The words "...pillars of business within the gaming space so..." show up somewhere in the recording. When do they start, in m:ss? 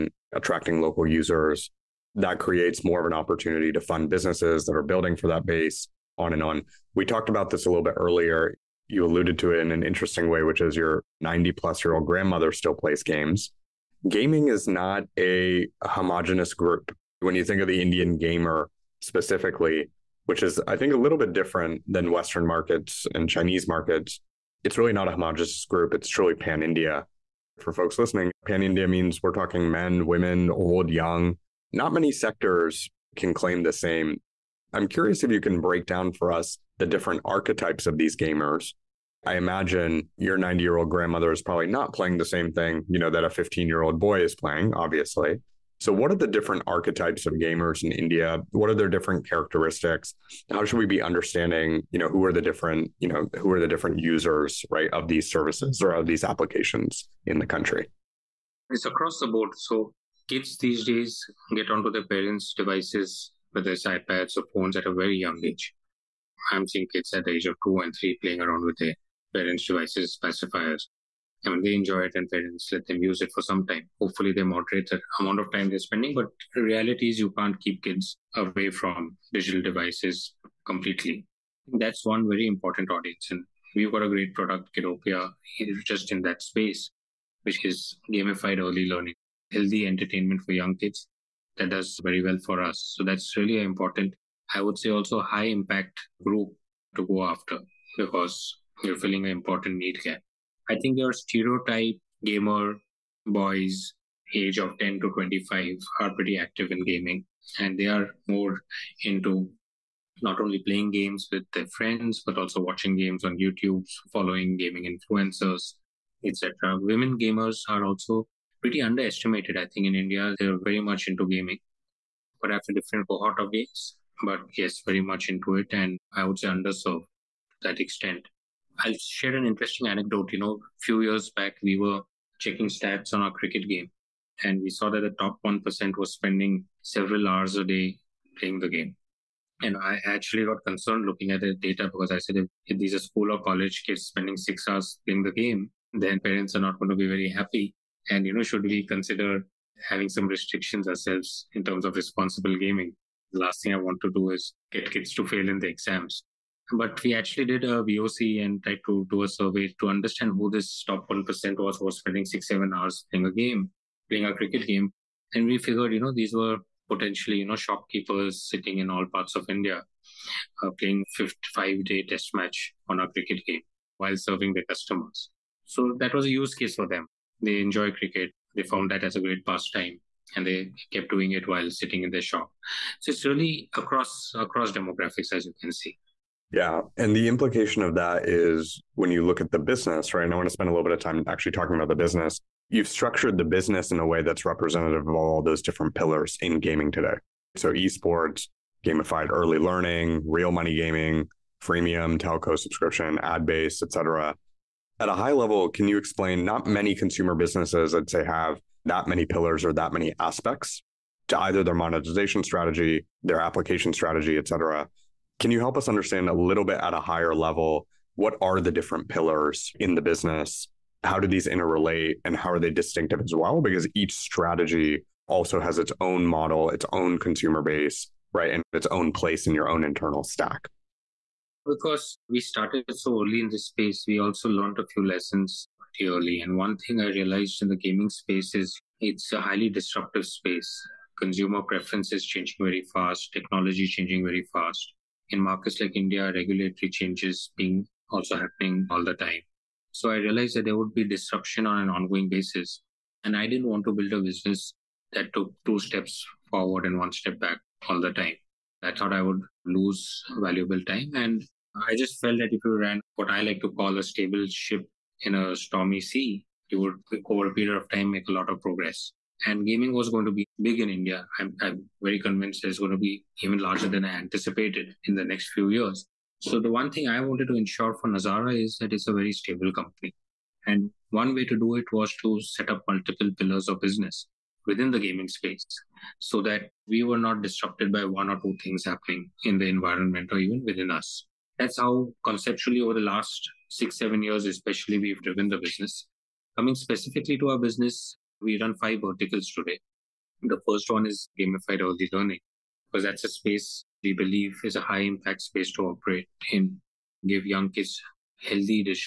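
4:43.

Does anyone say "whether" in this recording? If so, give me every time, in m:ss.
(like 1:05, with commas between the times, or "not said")
1:03.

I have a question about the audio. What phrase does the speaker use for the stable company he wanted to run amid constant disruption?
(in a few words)
stable ship in a stormy sea.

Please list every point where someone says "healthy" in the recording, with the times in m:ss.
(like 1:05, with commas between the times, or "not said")
1:29, 5:08.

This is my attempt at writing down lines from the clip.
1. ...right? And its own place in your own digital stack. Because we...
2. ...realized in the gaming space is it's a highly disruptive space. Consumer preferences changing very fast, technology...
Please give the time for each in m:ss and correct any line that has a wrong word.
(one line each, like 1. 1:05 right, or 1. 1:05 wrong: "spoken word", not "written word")
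1. 3:48 wrong: "internal", not "digital"
2. 3:57 right.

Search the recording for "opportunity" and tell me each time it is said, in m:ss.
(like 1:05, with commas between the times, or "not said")
0:03.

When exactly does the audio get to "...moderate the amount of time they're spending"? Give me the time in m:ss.
1:14.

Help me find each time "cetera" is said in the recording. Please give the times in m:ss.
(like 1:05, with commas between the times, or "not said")
3:23, 3:34.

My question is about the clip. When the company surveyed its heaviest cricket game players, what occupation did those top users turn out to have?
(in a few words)
Shopkeepers.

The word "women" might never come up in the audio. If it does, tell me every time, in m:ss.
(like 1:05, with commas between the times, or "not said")
0:30, 1:56.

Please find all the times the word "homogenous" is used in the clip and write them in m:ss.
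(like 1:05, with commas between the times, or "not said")
0:15, 0:25.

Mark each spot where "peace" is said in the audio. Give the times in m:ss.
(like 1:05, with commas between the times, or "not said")
not said.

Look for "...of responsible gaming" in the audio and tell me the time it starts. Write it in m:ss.
2:31.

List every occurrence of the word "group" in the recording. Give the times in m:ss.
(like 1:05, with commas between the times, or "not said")
0:16, 0:25, 1:36.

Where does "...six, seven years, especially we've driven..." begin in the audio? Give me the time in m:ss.
4:53.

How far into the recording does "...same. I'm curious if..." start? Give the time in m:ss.
0:33.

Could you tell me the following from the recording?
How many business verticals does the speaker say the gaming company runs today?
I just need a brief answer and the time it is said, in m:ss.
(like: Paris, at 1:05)
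5, at 4:58.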